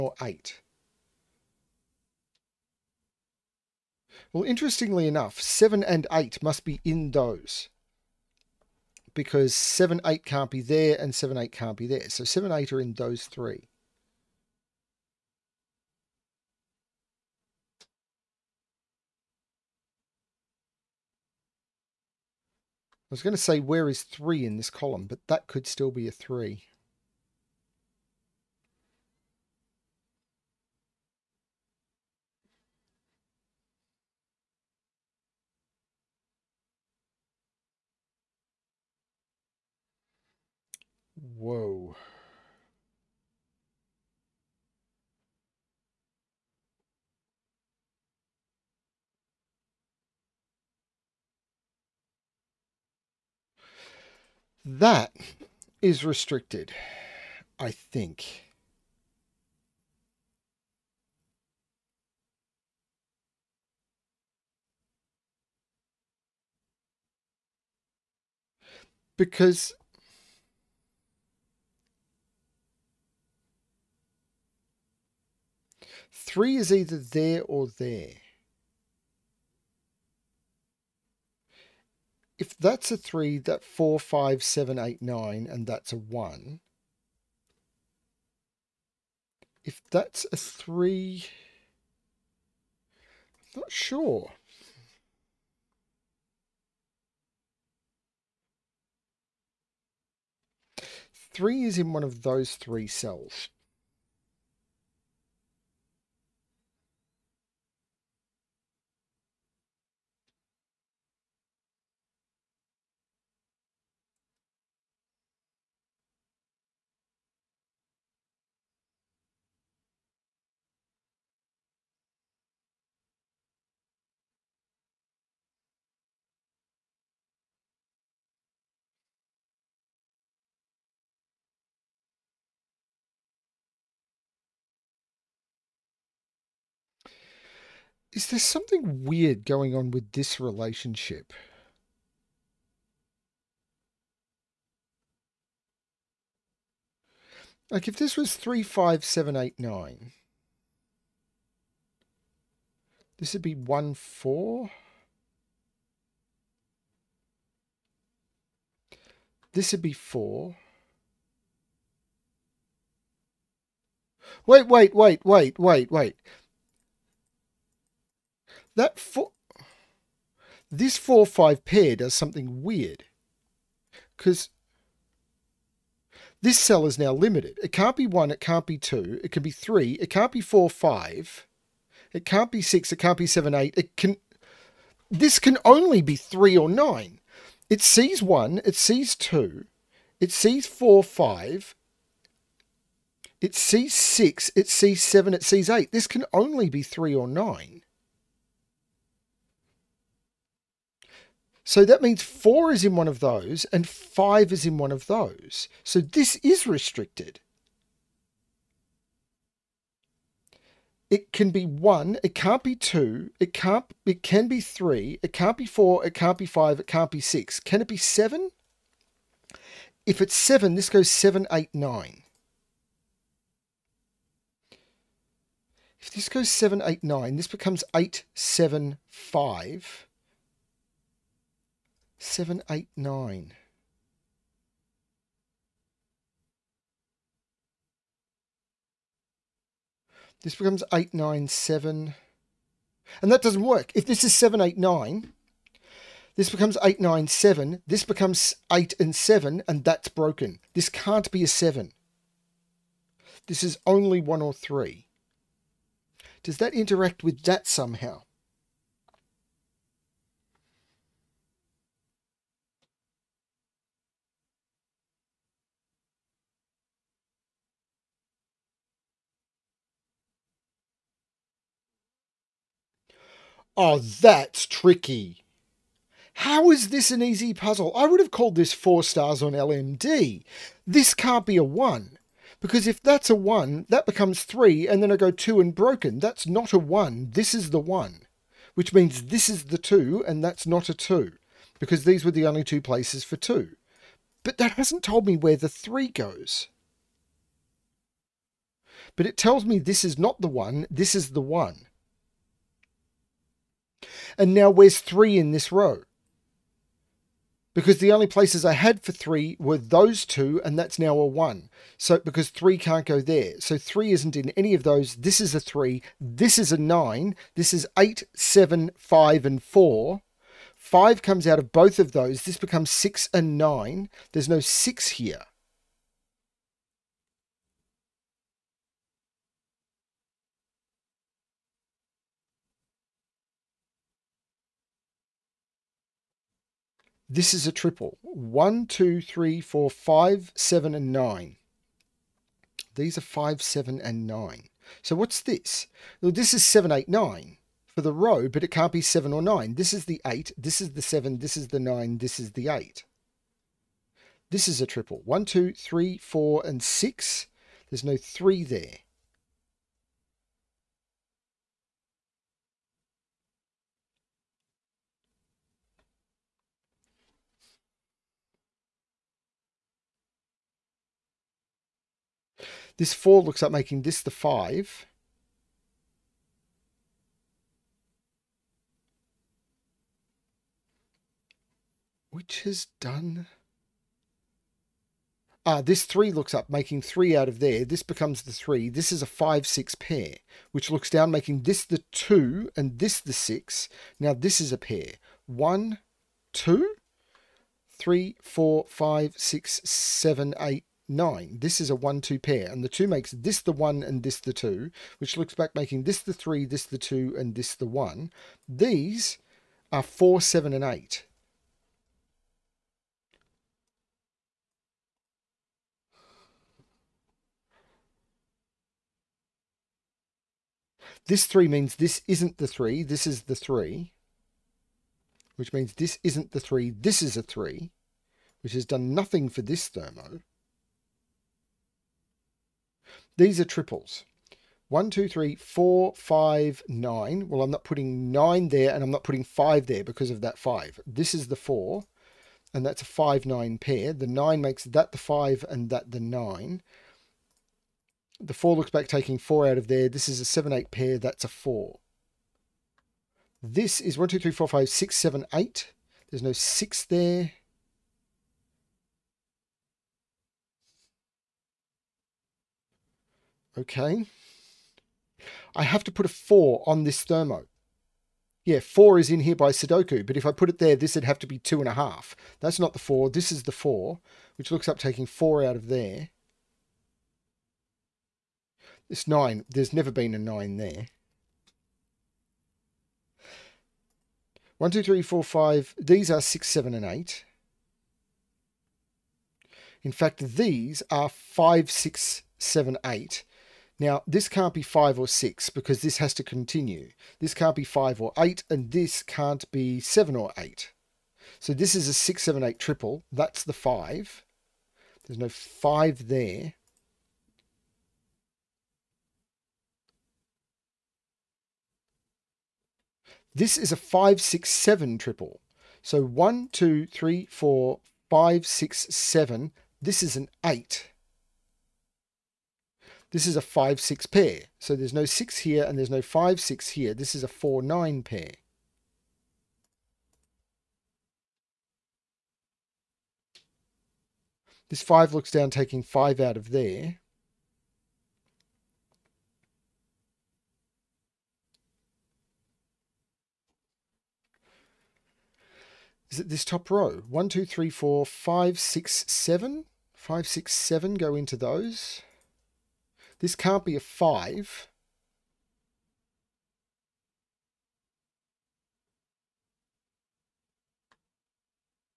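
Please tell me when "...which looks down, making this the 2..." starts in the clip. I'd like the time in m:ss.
6:30.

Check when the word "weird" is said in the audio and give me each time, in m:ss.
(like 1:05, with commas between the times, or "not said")
2:19, 2:52.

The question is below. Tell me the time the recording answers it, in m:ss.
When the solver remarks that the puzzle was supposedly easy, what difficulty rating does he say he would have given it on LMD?
4:38.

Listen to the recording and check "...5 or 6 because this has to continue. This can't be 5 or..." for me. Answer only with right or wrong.
right.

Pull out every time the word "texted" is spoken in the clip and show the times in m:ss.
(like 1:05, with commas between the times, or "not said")
not said.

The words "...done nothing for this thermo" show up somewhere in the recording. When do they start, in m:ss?
7:08.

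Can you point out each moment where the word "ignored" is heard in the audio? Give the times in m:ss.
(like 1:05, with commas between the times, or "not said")
not said.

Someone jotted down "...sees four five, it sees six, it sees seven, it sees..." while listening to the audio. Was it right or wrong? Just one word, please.
right.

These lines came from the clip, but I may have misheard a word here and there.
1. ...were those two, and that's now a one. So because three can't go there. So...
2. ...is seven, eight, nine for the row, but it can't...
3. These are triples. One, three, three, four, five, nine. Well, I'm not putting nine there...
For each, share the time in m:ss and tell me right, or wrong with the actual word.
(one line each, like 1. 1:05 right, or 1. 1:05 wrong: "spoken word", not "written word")
1. 5:09 right
2. 5:46 right
3. 7:13 wrong: "two", not "three".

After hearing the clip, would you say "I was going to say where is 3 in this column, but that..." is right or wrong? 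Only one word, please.
right.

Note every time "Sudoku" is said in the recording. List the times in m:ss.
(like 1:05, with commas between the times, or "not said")
7:49.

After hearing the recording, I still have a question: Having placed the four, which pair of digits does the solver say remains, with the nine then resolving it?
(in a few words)
5 and 9.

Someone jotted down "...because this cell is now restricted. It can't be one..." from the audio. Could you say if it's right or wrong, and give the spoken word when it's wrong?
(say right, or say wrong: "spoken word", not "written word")
wrong: "limited", not "restricted".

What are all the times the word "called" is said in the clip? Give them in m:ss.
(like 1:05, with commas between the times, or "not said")
4:38.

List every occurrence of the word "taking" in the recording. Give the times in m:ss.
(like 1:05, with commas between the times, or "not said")
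7:29, 7:54, 8:55.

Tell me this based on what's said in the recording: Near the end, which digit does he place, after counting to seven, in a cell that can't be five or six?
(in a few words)
8.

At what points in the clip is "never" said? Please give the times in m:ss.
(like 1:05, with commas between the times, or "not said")
7:59.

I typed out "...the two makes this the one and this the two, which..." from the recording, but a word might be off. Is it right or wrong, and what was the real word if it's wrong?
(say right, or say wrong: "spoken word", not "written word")
right.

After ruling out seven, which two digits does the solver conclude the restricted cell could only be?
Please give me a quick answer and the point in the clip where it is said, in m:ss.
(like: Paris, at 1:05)
1 or 3, at 4:14.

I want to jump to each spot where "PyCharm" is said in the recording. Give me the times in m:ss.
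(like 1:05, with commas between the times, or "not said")
not said.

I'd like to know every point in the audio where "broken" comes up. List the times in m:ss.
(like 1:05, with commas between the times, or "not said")
4:10, 4:45.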